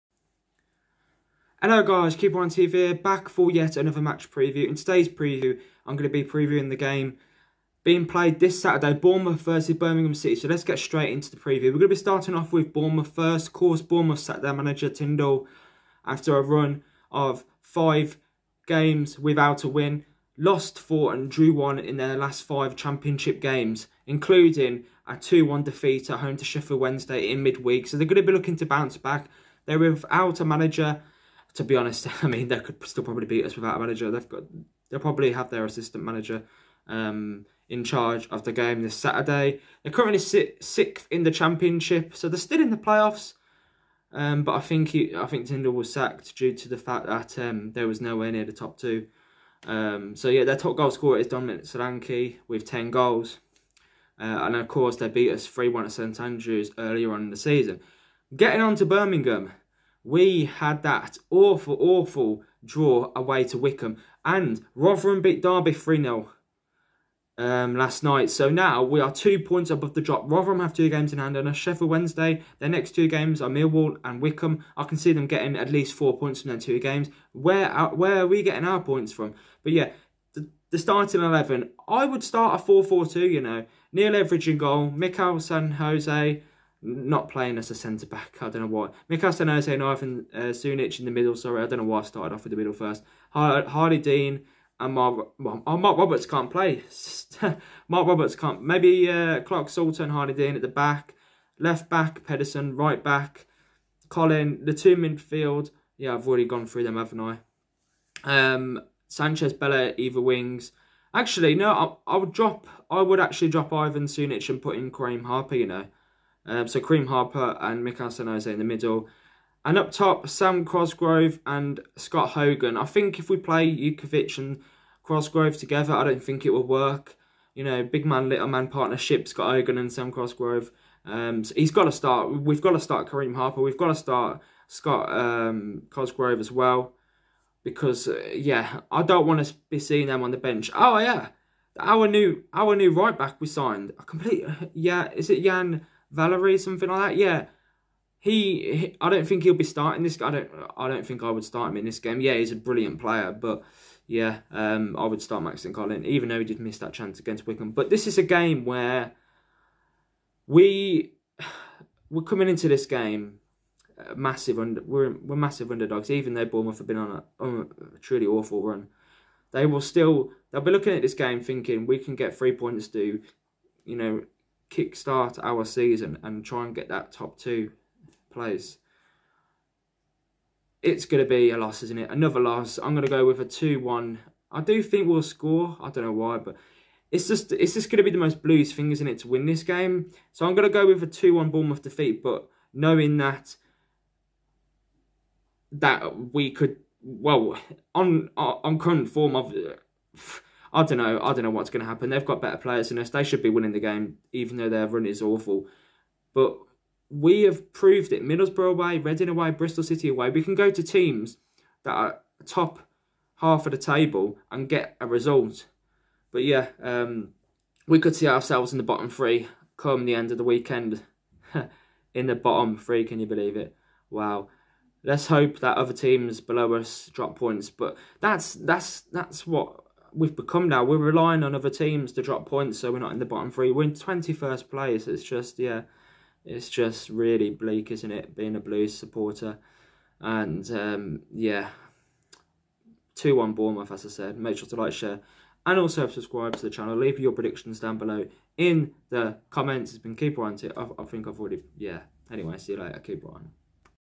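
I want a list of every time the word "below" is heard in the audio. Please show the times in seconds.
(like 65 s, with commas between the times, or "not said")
226 s, 247 s.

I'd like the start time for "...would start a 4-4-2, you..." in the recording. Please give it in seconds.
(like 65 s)
82 s.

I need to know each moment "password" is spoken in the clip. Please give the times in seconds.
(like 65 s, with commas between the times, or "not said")
not said.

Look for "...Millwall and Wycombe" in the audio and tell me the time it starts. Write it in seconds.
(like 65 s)
73 s.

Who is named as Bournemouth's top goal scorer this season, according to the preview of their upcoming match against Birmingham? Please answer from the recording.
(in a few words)
Dominic Solanke.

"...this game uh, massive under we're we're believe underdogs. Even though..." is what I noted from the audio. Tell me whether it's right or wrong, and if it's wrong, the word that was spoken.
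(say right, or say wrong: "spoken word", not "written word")
wrong: "massive", not "believe".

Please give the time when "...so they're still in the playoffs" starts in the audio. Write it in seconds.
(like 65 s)
42 s.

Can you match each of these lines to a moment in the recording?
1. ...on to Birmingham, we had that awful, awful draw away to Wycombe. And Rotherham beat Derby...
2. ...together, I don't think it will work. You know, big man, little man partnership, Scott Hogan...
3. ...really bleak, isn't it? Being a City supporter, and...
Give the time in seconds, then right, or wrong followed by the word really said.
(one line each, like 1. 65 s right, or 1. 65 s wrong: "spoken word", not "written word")
1. 58 s right
2. 125 s right
3. 237 s wrong: "Blues", not "City".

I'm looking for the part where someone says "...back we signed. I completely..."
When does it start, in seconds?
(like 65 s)
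143 s.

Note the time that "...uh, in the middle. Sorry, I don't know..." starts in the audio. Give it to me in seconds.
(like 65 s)
90 s.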